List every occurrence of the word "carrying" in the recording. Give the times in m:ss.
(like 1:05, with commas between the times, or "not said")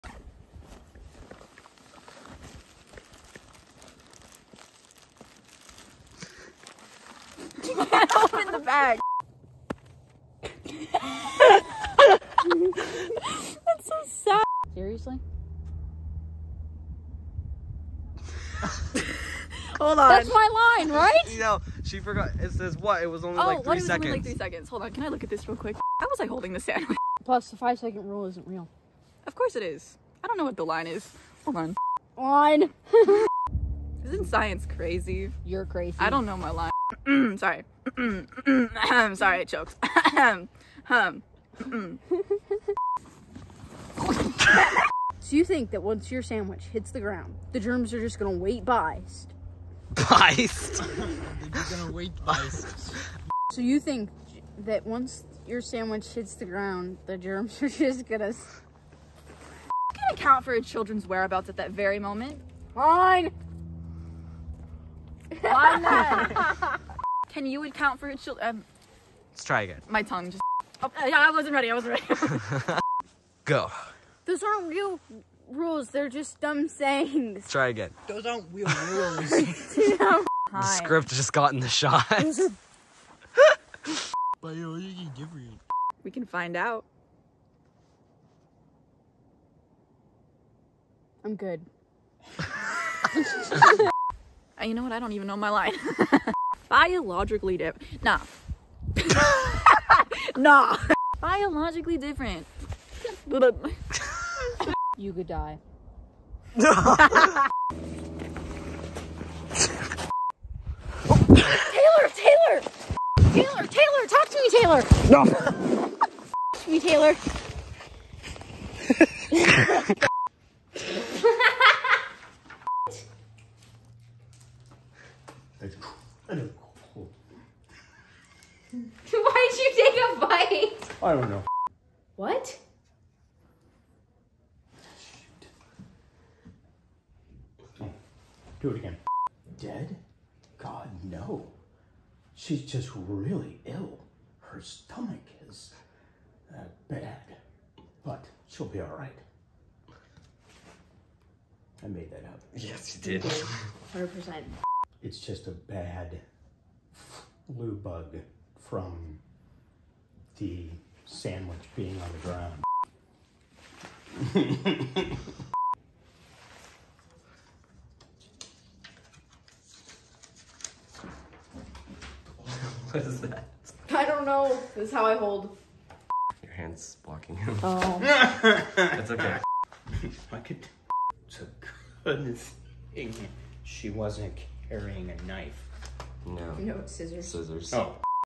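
3:04.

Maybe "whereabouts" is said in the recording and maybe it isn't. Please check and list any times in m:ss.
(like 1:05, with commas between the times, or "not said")
1:01.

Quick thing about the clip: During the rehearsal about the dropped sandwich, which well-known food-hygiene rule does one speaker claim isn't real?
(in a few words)
5 second rule.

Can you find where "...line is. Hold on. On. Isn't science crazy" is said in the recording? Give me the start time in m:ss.
0:30.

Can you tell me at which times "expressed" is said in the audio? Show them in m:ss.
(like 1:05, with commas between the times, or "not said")
not said.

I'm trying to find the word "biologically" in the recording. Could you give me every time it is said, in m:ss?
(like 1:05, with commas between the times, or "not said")
1:36, 1:41.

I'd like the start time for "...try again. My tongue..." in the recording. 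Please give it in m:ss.
1:09.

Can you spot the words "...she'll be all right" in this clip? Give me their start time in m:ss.
2:28.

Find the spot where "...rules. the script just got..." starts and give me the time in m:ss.
1:18.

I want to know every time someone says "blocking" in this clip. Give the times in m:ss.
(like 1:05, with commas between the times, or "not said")
2:57.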